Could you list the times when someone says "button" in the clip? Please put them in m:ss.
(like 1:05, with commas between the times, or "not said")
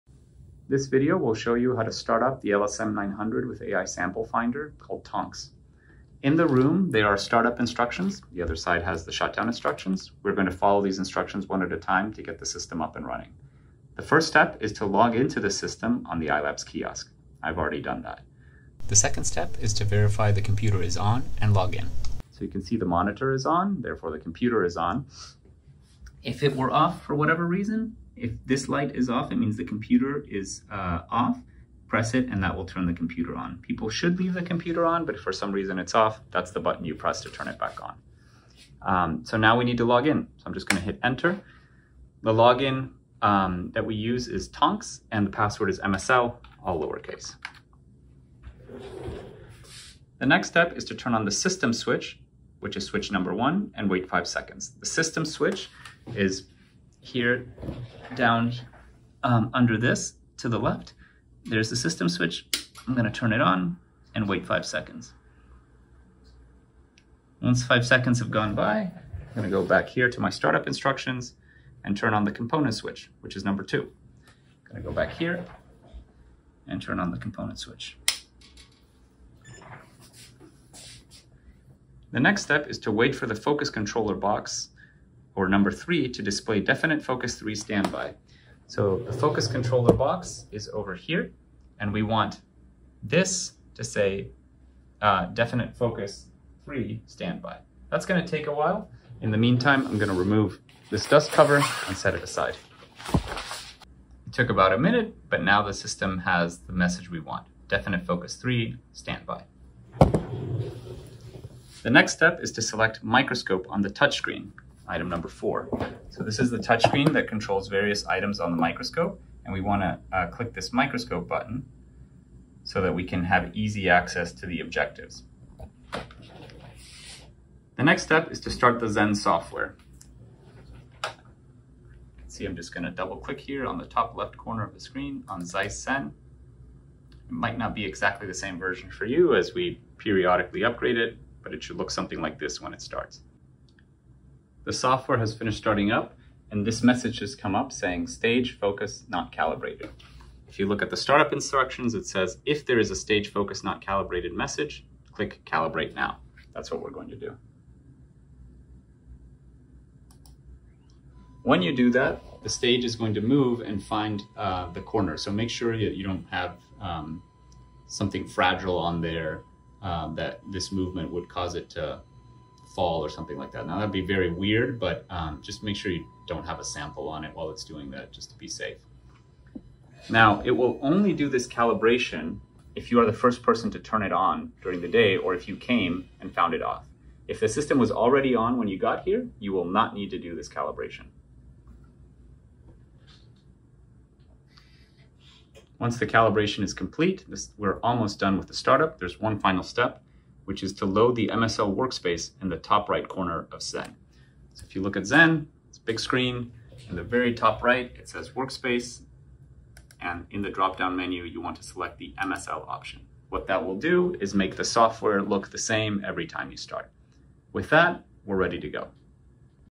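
0:36, 2:01.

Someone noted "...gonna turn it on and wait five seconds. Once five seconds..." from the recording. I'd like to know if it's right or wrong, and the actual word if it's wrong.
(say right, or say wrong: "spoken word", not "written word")
right.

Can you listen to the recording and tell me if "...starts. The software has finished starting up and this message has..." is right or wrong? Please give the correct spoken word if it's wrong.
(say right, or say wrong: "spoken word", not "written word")
right.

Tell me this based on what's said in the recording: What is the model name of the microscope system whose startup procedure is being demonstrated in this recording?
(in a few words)
LSM900.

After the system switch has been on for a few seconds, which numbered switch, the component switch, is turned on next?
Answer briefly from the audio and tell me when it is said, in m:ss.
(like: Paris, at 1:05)
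number 2, at 1:13.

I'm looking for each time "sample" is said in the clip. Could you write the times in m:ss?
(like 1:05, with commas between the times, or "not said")
0:03, 2:56.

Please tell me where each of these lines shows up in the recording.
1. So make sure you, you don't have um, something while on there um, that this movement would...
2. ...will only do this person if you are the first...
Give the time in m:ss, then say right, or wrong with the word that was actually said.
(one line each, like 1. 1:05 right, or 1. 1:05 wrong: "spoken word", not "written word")
1. 2:45 wrong: "fragile", not "while"
2. 3:00 wrong: "calibration", not "person".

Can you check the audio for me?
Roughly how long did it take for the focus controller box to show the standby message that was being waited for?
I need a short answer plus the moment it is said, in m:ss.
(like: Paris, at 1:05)
about a minute, at 1:44.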